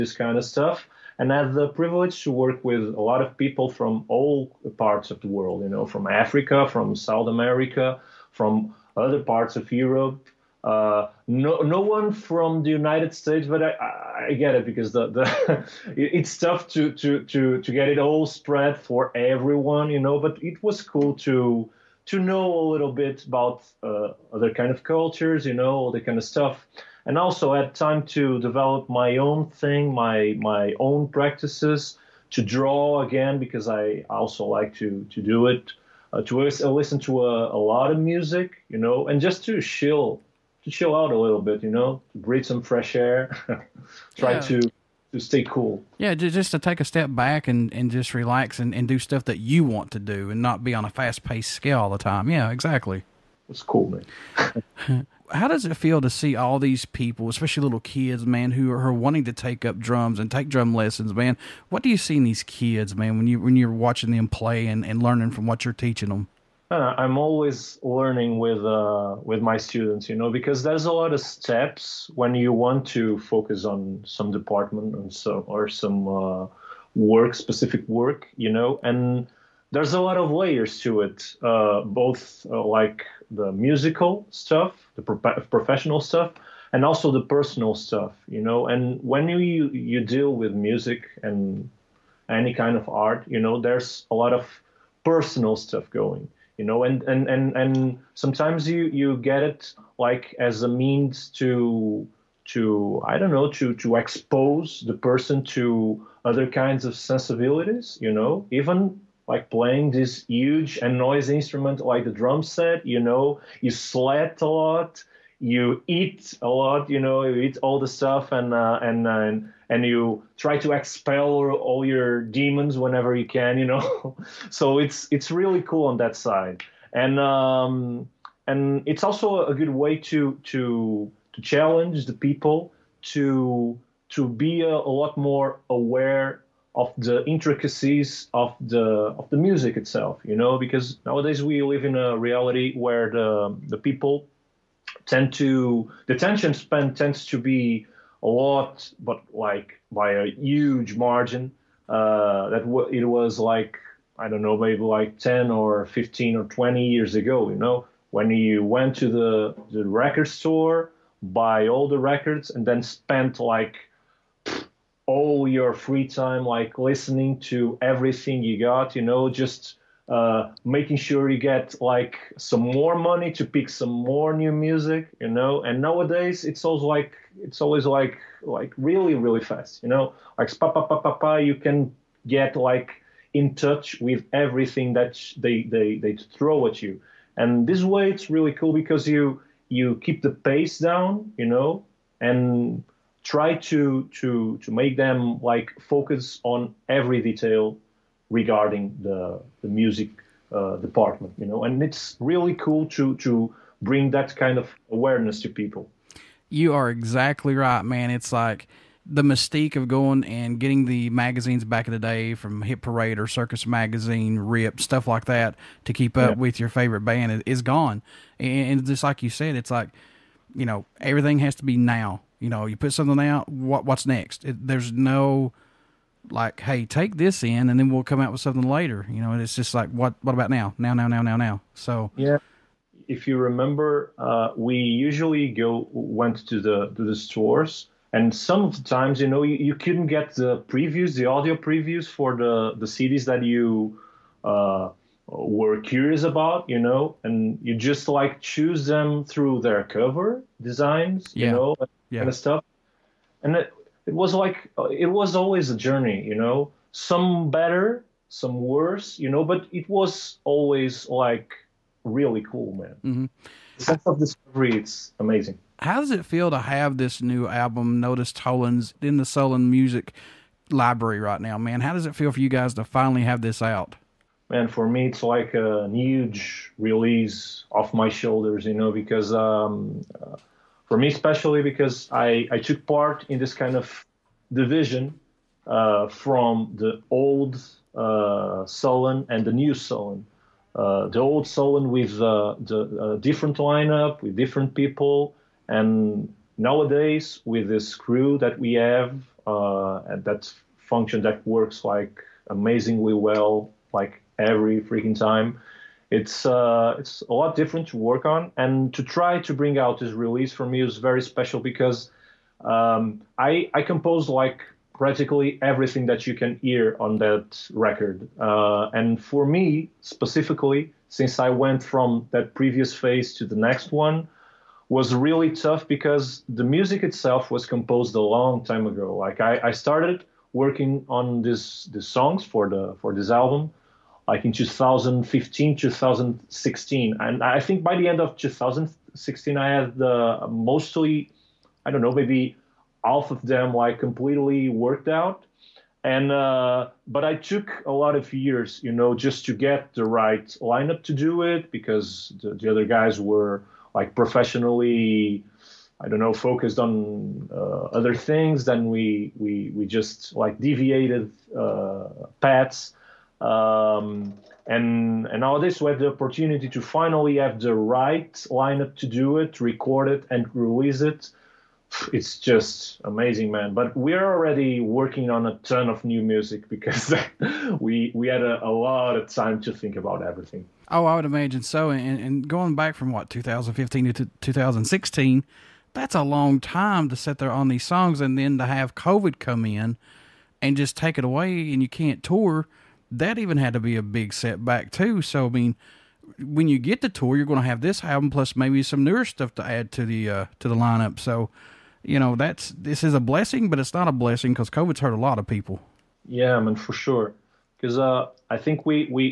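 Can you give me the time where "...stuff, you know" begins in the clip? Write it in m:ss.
1:27.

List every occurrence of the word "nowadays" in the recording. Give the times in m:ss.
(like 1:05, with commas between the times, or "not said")
2:21, 2:55, 4:56.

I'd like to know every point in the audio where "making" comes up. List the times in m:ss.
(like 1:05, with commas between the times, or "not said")
2:50.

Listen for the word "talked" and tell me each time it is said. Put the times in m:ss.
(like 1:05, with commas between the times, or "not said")
not said.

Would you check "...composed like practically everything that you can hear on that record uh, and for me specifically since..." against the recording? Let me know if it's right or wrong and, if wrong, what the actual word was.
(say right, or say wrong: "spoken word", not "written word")
right.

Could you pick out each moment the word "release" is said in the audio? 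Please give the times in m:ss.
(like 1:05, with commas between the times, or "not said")
4:36, 5:10, 6:10.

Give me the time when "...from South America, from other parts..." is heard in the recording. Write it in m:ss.
0:06.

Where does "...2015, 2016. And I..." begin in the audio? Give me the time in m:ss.
5:34.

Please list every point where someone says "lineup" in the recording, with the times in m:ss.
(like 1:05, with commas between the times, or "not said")
4:53, 5:50, 6:08, 6:40.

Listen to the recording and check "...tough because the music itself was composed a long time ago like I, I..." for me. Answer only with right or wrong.
right.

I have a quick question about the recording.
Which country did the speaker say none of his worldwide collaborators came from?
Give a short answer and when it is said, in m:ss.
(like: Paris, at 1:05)
United States, at 0:12.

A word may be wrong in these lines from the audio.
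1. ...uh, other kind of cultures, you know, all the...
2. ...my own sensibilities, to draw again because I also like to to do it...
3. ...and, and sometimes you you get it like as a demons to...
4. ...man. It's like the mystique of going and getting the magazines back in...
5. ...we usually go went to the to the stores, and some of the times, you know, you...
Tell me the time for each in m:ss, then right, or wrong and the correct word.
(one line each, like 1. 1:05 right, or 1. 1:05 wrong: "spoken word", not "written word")
1. 0:23 right
2. 0:30 wrong: "practices", not "sensibilities"
3. 1:37 wrong: "means", not "demons"
4. 3:27 right
5. 3:54 right.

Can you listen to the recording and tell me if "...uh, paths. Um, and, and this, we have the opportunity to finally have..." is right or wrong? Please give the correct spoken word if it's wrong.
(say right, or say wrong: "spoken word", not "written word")
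right.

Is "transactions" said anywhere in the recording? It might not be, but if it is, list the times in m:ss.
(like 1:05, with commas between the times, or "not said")
not said.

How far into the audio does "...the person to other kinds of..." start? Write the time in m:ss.
1:44.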